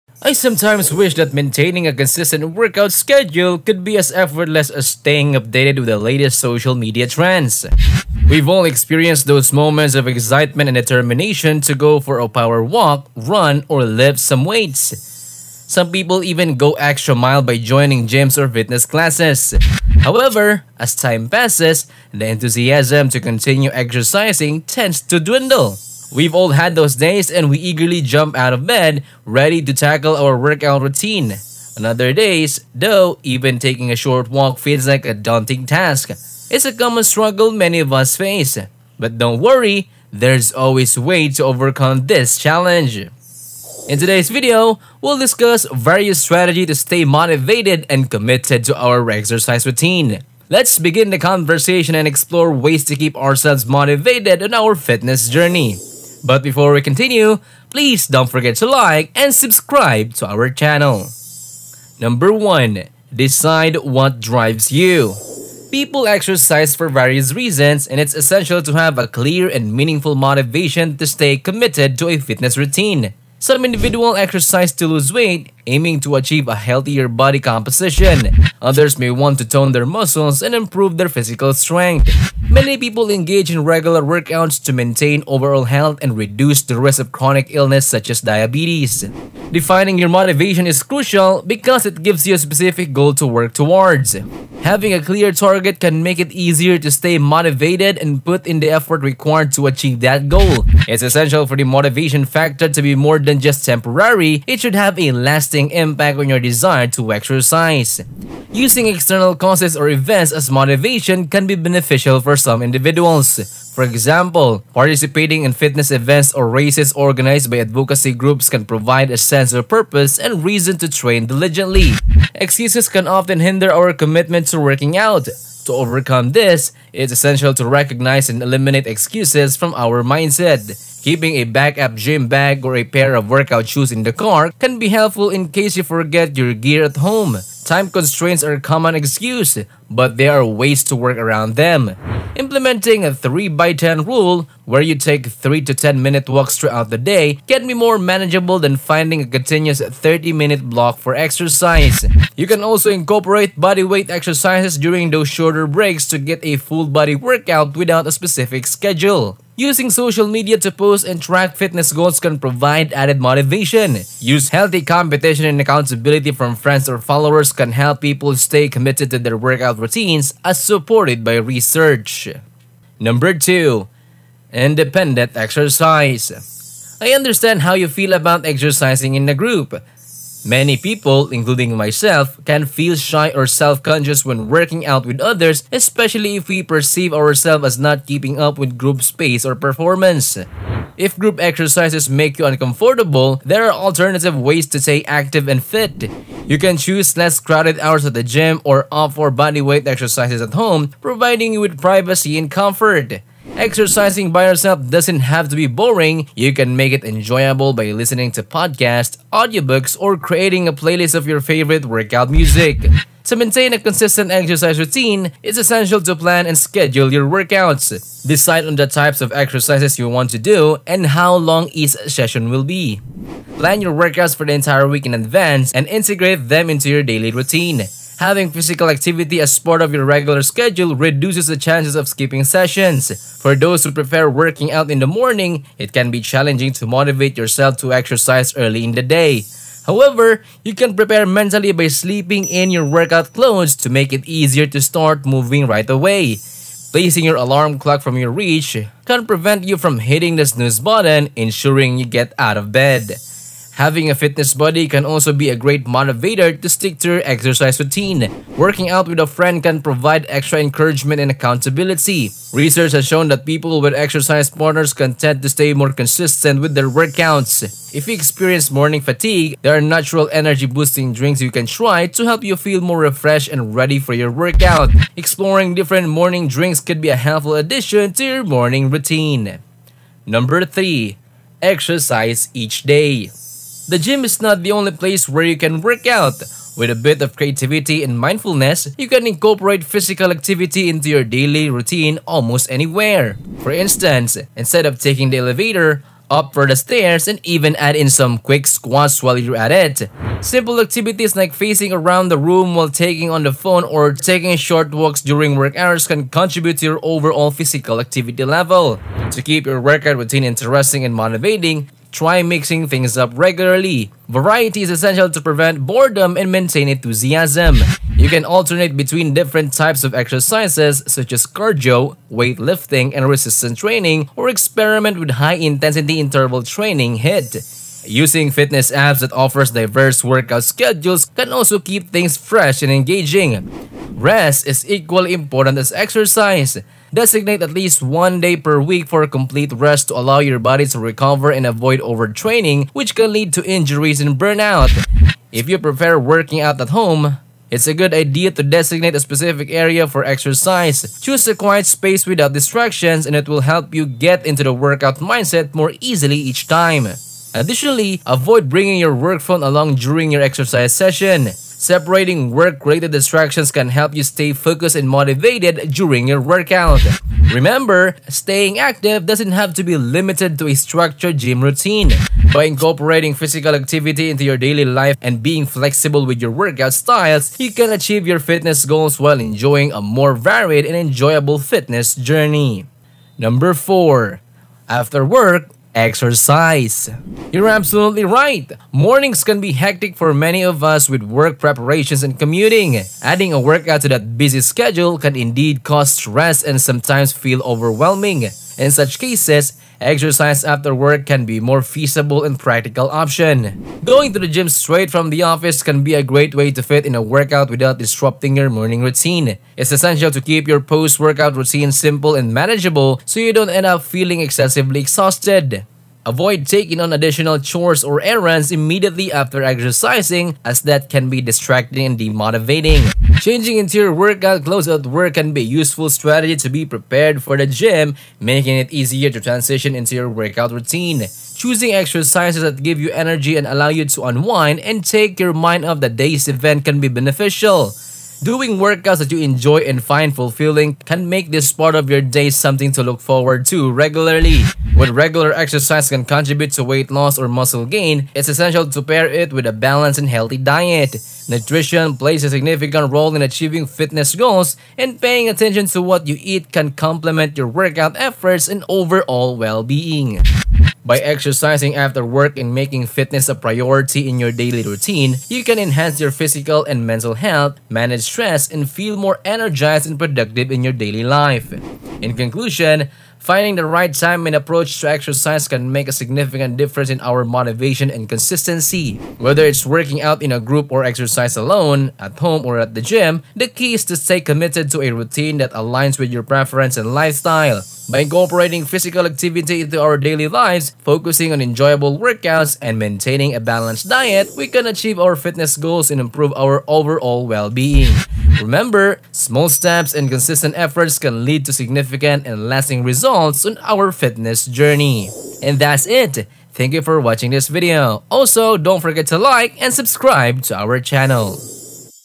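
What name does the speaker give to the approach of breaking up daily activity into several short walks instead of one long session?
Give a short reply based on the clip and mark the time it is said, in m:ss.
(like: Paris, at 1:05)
3 by 10 rule, at 2:23.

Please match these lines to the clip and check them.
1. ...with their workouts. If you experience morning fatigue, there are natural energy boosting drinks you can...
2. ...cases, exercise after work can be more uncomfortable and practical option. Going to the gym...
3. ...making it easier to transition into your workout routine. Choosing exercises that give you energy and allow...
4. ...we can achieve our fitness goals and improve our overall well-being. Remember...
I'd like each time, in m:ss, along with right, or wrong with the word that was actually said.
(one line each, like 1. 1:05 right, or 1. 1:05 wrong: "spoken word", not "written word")
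1. 4:26 right
2. 6:39 wrong: "feasible", not "uncomfortable"
3. 7:08 right
4. 8:14 right.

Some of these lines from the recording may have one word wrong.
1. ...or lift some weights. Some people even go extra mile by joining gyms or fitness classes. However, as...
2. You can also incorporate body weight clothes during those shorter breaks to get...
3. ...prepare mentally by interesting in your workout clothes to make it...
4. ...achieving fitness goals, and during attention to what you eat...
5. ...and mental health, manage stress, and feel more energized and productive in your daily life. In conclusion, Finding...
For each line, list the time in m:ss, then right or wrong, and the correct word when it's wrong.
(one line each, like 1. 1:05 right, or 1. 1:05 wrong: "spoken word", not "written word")
1. 0:13 right
2. 2:32 wrong: "exercises", not "clothes"
3. 4:00 wrong: "sleeping", not "interesting"
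4. 7:33 wrong: "paying", not "during"
5. 7:46 right.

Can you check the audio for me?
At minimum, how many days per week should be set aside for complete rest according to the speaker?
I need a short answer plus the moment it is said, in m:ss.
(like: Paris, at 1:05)
1, at 5:38.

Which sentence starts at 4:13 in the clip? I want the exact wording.
Having a fitness buddy can also be a great motivator to stick to your exercise routine.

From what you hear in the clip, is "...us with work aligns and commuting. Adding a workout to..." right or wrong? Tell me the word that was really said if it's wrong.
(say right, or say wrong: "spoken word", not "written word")
wrong: "preparations", not "aligns".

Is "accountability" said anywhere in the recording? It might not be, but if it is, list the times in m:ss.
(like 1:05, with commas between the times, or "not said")
2:45, 4:21.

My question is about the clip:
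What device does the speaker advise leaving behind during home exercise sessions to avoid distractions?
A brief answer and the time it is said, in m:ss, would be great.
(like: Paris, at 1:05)
work phone, at 5:59.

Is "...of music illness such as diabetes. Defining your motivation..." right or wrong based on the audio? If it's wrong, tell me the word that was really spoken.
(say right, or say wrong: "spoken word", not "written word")
wrong: "chronic", not "music".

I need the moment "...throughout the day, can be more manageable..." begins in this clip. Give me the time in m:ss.
2:26.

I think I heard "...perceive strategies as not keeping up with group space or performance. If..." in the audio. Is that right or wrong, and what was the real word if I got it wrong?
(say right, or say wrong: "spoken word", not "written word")
wrong: "ourselves", not "strategies".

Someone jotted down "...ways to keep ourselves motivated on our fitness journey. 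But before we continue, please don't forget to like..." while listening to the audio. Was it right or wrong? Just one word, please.
right.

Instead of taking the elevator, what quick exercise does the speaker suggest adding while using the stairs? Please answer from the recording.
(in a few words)
squats.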